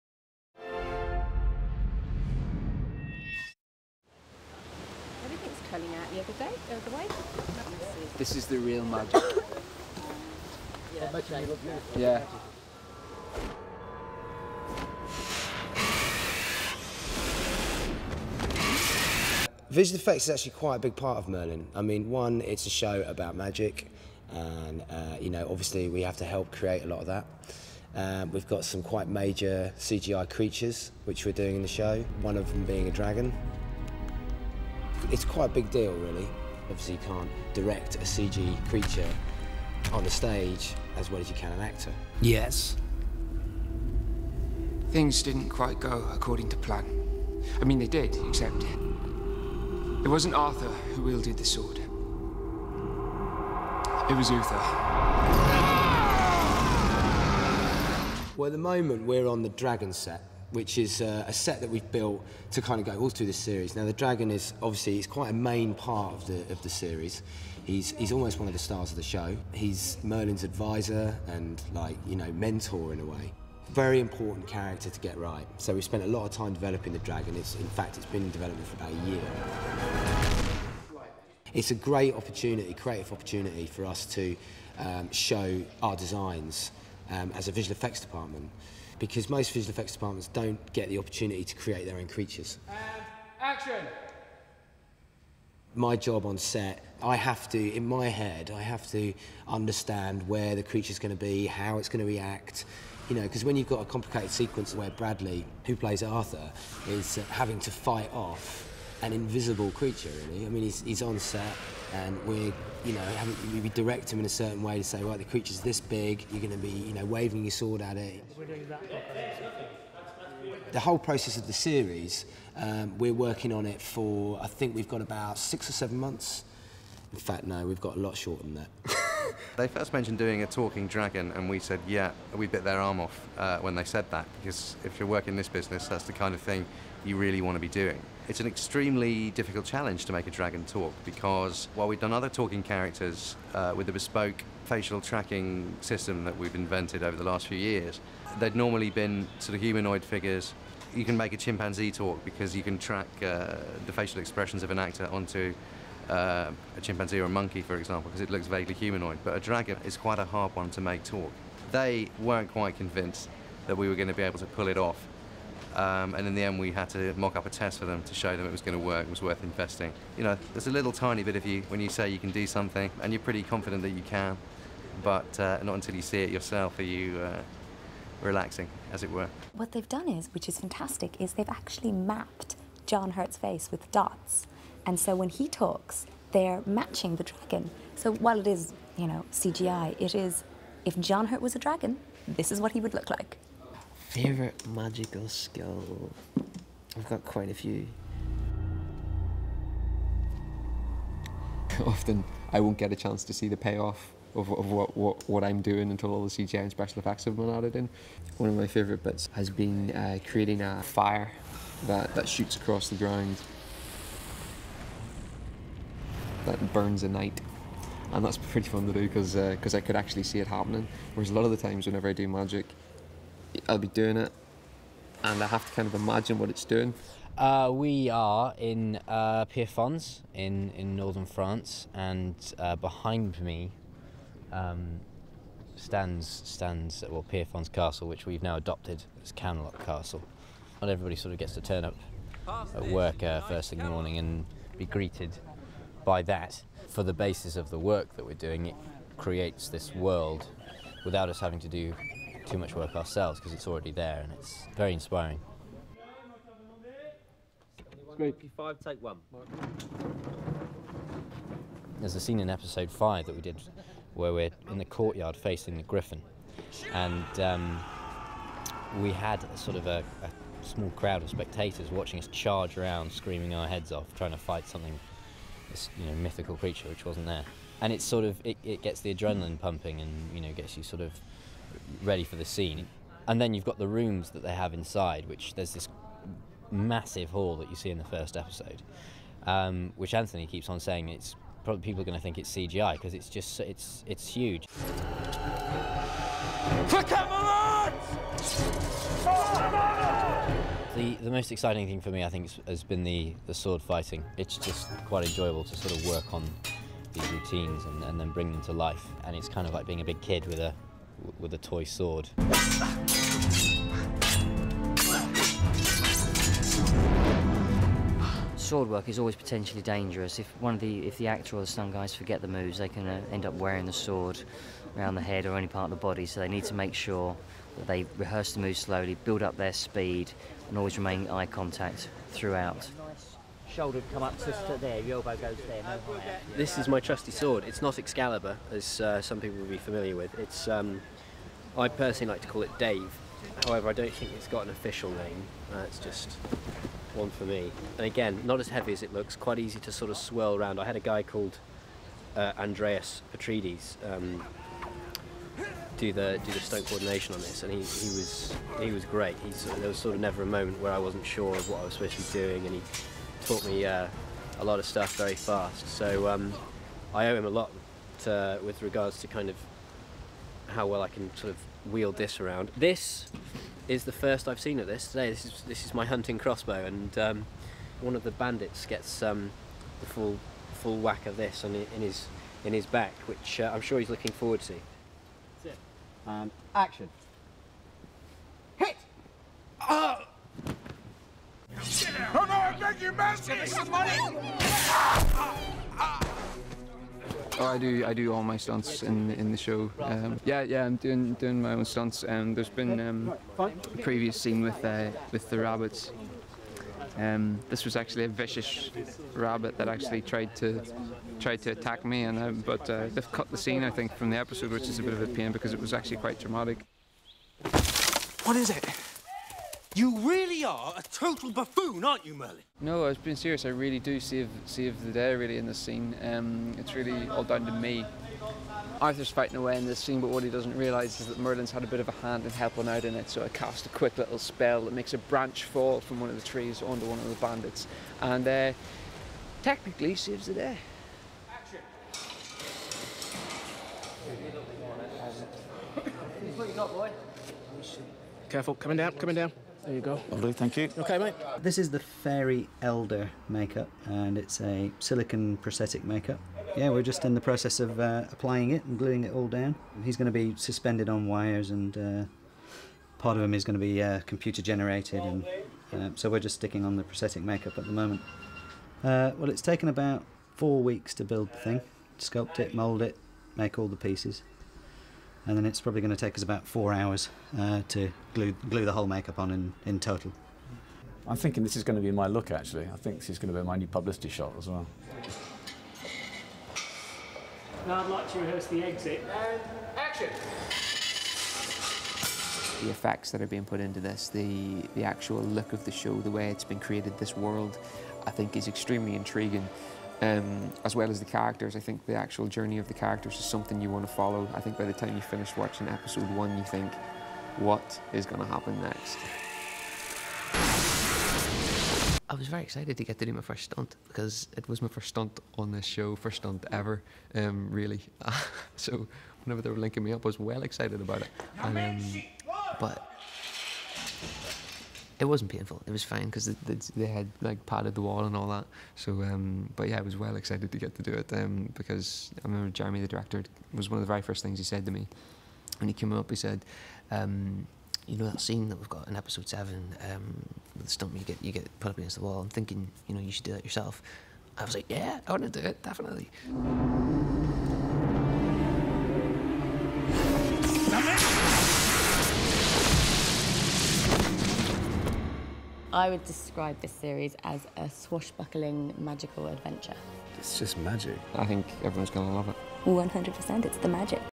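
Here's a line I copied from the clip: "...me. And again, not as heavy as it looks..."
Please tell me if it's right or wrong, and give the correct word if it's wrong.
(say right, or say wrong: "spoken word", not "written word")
right.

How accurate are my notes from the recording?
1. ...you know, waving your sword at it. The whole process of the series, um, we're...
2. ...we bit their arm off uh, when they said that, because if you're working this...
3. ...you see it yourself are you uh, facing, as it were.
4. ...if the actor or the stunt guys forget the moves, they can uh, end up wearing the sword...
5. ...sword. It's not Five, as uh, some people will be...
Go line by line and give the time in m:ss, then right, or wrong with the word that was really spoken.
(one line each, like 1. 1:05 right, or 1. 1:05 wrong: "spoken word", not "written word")
1. 1:56 right
2. 2:12 right
3. 2:55 wrong: "relaxing", not "facing"
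4. 5:21 right
5. 5:37 wrong: "Excalibur", not "Five".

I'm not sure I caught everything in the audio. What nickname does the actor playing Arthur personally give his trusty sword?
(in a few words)
Dave.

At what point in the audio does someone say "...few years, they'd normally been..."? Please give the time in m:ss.
2:27.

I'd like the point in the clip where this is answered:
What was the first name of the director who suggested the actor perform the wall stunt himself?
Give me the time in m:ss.
8:52.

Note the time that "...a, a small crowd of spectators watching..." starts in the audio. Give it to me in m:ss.
4:29.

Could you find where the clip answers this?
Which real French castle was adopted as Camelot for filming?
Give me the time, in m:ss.
3:57.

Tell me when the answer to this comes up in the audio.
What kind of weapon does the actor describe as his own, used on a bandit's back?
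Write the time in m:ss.
6:16.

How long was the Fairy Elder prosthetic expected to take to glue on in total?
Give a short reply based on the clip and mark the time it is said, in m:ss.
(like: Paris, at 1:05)
About 4 hours, at 7:56.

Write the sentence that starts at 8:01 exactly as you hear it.
I'm thinking this is going to be my look actually.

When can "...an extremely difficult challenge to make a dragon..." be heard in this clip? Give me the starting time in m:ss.
2:18.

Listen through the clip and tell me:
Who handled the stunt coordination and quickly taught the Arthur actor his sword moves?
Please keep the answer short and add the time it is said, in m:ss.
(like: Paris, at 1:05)
Andreas Petrides, at 5:52.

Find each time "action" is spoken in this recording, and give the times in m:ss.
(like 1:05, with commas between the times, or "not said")
1:33, 6:26, 7:21, 8:09.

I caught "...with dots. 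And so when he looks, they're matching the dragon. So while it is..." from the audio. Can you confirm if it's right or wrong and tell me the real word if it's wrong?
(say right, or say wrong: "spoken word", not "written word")
wrong: "talks", not "looks".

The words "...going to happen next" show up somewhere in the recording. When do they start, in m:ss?
8:28.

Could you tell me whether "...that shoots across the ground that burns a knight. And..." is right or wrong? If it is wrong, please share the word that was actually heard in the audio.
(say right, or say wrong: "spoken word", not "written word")
right.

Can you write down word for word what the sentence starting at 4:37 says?
And it's sort of it, it gets the adrenaline pumping and you know gets you sort of ready for the scene.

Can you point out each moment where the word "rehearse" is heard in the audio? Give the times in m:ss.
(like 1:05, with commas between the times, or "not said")
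5:28, 8:08.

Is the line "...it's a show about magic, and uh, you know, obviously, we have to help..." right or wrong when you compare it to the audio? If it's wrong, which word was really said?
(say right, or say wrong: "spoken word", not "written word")
right.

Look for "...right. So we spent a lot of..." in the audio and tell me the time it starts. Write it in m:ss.
1:15.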